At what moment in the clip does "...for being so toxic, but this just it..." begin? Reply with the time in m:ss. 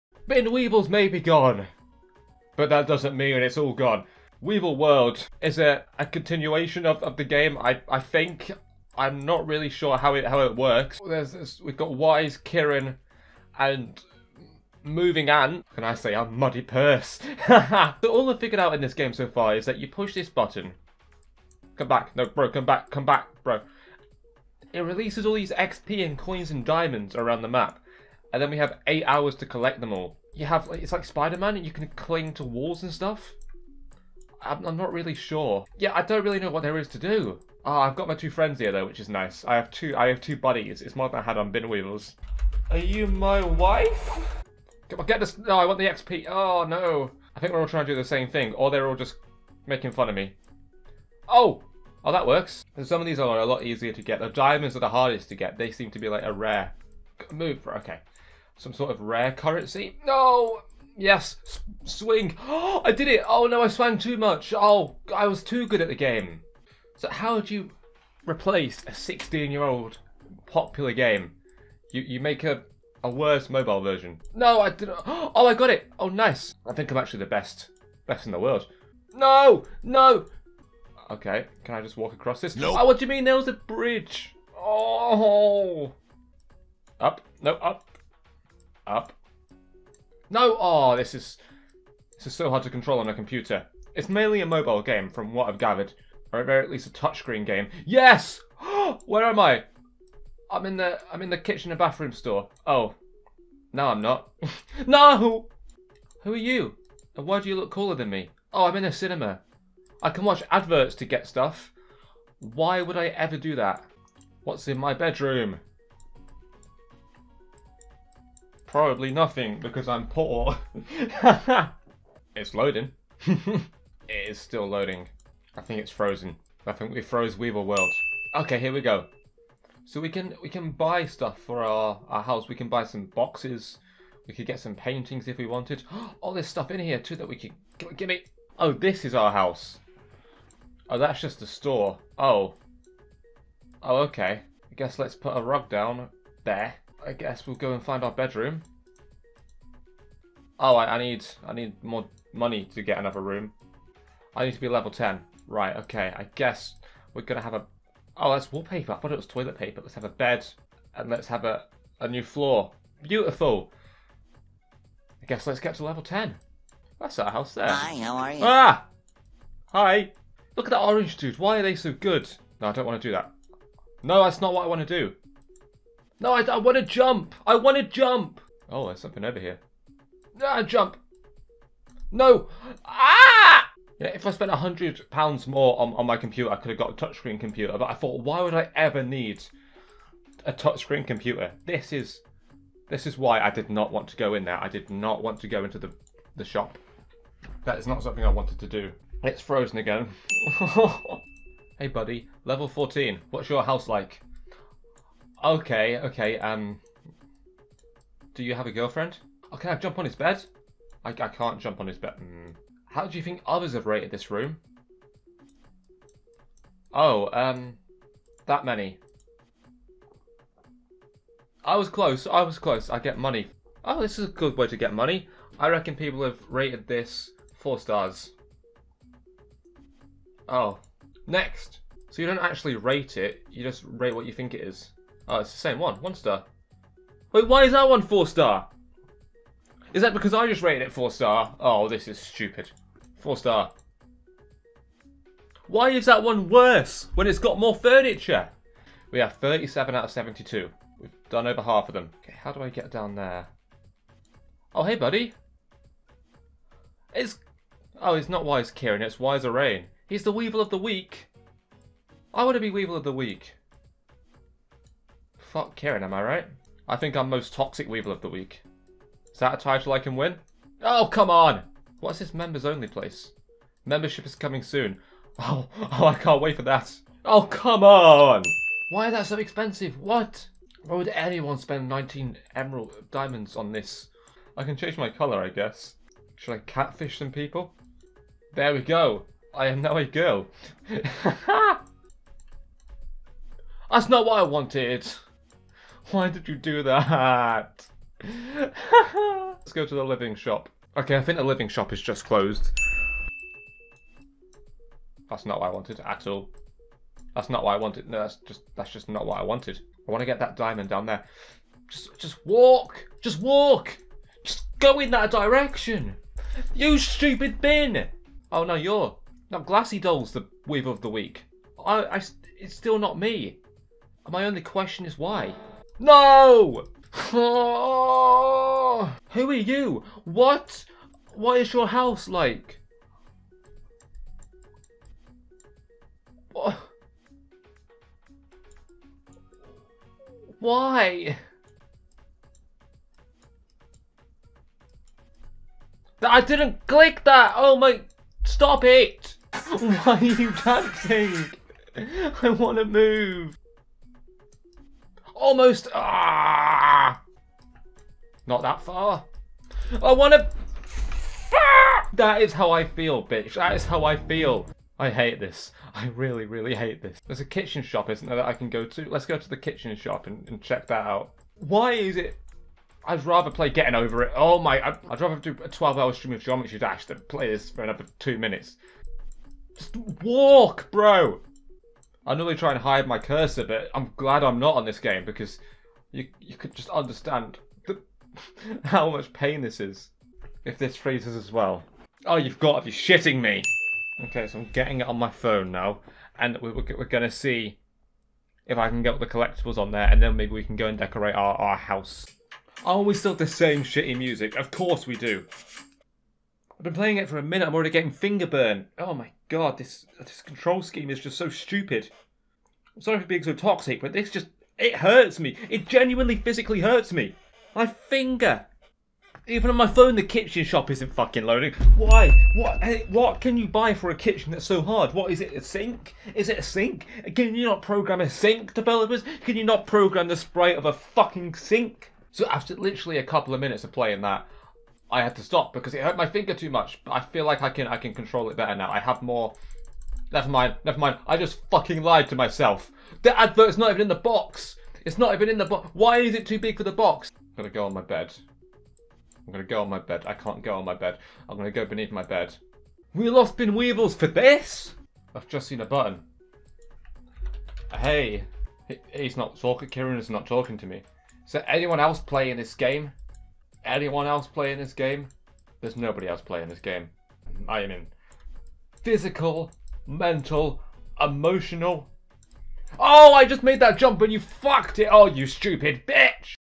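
6:53.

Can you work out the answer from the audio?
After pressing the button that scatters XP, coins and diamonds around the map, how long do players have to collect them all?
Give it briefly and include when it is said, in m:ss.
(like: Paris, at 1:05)
8 hours, at 0:28.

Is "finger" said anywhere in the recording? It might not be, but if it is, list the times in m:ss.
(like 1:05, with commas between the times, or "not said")
6:48, 6:57, 7:16.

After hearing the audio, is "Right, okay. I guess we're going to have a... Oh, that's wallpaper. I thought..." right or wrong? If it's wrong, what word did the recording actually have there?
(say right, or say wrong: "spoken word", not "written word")
right.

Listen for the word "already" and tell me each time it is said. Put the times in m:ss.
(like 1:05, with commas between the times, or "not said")
6:47.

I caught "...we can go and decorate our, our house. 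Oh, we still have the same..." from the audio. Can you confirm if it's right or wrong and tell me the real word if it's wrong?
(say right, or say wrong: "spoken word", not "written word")
right.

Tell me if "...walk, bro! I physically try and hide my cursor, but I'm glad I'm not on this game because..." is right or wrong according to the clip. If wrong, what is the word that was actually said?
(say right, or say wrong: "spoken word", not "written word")
wrong: "normally", not "physically".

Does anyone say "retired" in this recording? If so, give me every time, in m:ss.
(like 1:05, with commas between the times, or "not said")
not said.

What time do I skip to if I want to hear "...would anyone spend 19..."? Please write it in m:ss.
4:40.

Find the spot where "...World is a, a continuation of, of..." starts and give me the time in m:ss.
0:04.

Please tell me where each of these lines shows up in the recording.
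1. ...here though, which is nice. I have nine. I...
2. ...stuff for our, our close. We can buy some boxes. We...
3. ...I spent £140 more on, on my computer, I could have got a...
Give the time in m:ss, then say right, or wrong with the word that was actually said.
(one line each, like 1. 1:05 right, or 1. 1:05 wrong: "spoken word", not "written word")
1. 0:38 wrong: "two", not "nine"
2. 2:11 wrong: "house", not "close"
3. 3:04 wrong: "100", not "140".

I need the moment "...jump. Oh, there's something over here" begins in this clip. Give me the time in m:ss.
2:57.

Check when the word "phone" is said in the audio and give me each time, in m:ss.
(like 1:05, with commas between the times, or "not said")
6:35, 6:59.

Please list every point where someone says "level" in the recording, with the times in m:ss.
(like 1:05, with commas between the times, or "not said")
2:34, 2:45, 3:22.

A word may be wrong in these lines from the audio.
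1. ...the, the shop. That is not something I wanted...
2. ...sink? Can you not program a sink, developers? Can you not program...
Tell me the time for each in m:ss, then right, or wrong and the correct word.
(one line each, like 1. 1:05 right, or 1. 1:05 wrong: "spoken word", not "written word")
1. 3:15 right
2. 7:06 right.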